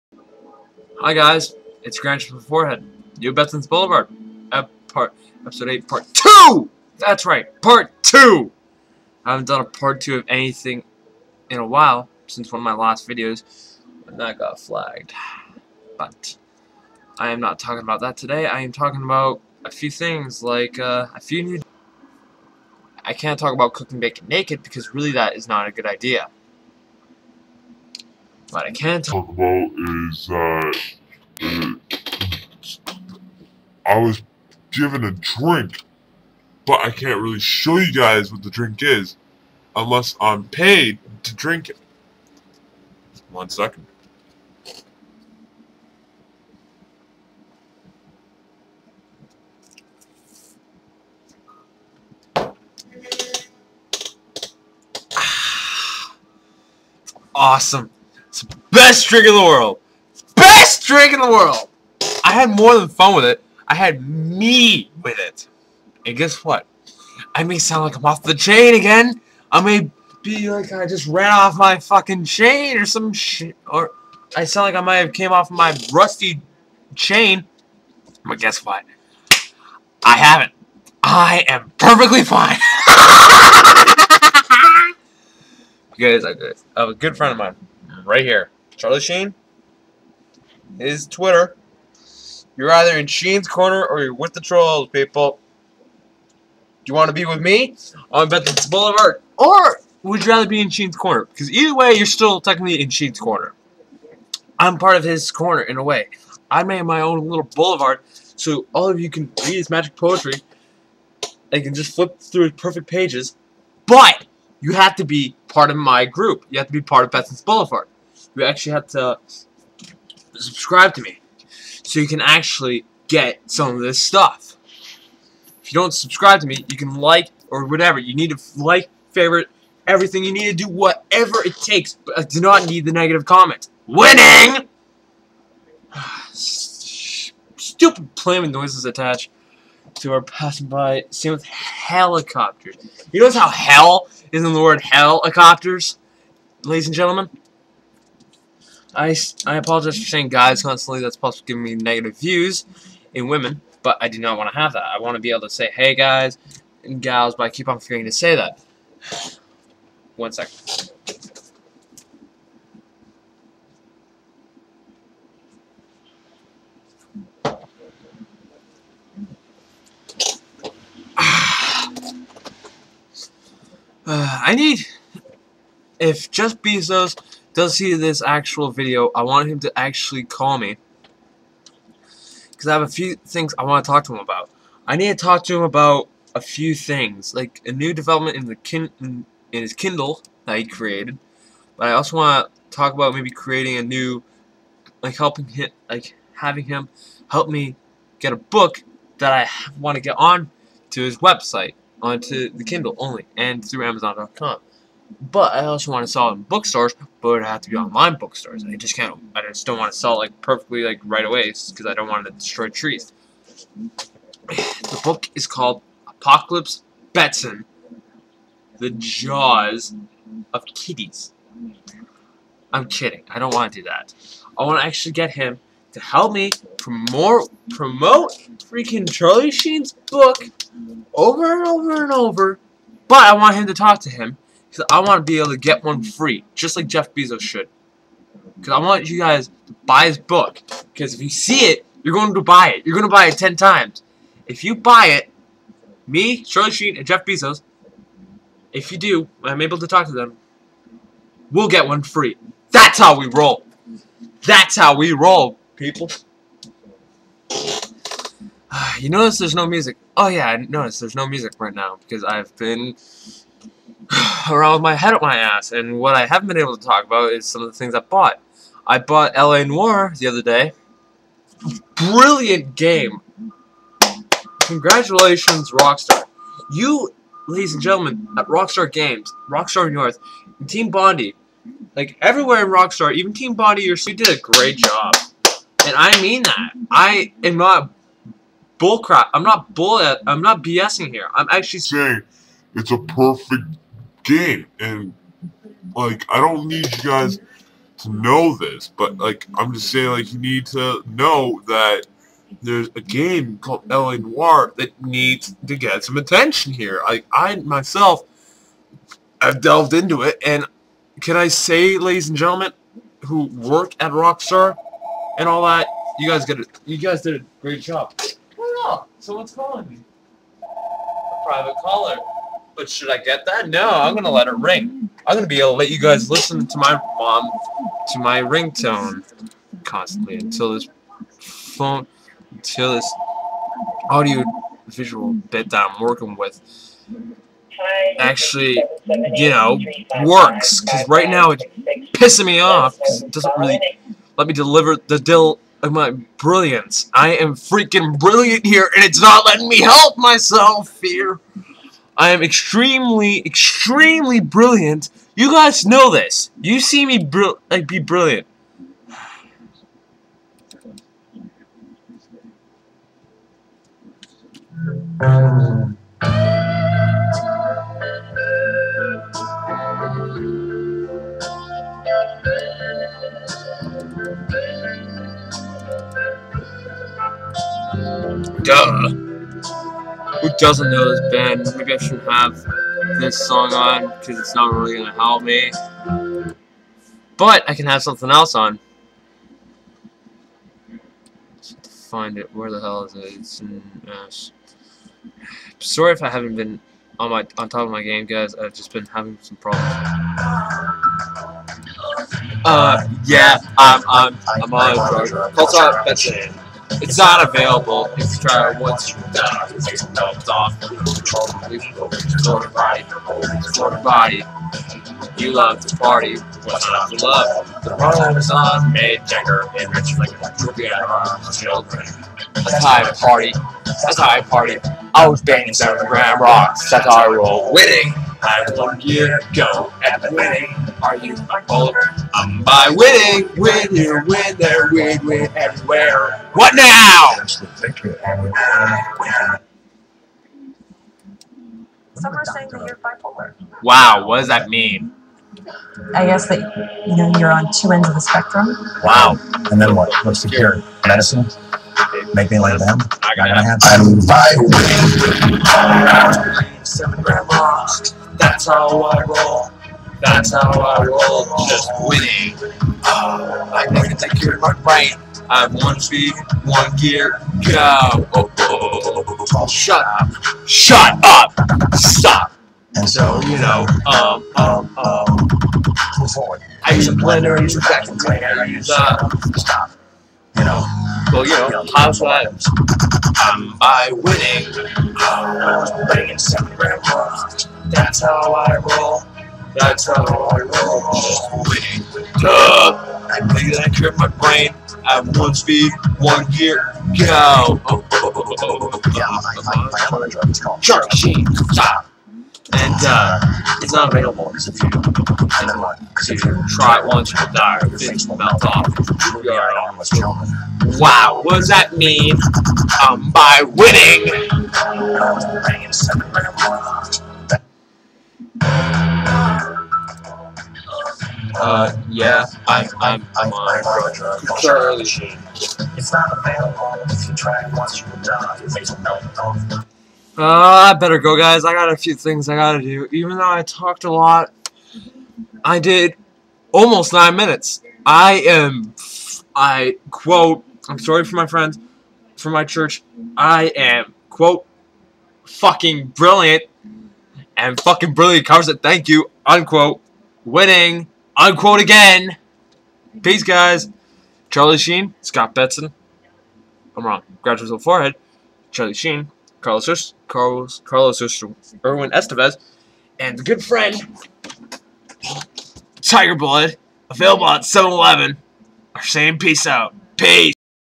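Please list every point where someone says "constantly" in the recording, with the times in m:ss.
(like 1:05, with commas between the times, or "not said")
2:30, 5:29.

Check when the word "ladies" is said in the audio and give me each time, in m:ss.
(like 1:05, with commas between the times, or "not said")
2:26, 4:37, 5:11.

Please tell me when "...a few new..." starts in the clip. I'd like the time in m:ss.
0:21.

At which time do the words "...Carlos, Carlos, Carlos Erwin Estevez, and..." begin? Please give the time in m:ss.
9:19.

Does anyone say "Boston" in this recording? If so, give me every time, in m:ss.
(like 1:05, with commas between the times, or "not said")
not said.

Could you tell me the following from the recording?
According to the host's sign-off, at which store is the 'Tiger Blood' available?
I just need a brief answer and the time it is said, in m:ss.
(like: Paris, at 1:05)
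7-Eleven, at 9:27.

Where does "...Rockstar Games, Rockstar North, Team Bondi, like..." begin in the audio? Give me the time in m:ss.
4:38.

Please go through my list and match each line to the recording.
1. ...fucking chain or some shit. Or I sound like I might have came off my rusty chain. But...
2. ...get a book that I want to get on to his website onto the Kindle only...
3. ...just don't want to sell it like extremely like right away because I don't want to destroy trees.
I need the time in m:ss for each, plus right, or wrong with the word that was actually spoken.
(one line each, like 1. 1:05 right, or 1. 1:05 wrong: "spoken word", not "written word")
1. 1:11 right
2. 3:18 right
3. 3:29 wrong: "perfectly", not "extremely".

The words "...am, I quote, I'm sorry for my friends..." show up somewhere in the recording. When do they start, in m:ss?
8:58.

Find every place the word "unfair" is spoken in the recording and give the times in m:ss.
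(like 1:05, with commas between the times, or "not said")
not said.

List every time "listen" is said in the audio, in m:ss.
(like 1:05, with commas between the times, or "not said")
5:26.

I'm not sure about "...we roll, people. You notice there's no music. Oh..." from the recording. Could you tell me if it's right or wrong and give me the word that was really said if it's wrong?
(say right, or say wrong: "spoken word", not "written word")
right.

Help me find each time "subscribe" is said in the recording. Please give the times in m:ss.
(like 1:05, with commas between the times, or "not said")
2:00, 2:05.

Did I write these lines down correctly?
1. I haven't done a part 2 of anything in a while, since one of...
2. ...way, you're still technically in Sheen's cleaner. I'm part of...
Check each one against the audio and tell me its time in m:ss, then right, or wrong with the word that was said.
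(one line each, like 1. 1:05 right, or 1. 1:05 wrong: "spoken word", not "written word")
1. 0:09 right
2. 1:41 wrong: "corner", not "cleaner".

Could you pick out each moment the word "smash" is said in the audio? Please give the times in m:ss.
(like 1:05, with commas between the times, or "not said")
not said.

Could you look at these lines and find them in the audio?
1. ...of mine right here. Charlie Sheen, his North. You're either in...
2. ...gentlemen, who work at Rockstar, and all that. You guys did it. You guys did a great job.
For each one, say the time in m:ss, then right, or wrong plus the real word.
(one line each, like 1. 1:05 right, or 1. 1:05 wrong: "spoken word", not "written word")
1. 1:27 wrong: "Twitter", not "North"
2. 5:12 right.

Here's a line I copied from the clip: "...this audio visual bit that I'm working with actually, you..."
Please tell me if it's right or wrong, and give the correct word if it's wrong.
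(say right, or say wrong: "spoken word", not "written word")
right.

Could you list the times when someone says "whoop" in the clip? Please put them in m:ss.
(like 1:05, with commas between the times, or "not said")
not said.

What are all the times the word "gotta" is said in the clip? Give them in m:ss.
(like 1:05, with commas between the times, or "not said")
7:33, 8:52.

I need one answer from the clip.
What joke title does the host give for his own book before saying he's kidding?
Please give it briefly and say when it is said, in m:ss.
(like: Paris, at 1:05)
Apocalypse Betson: The Jaws of Kitties, at 3:36.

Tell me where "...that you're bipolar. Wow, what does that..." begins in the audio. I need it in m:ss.
7:22.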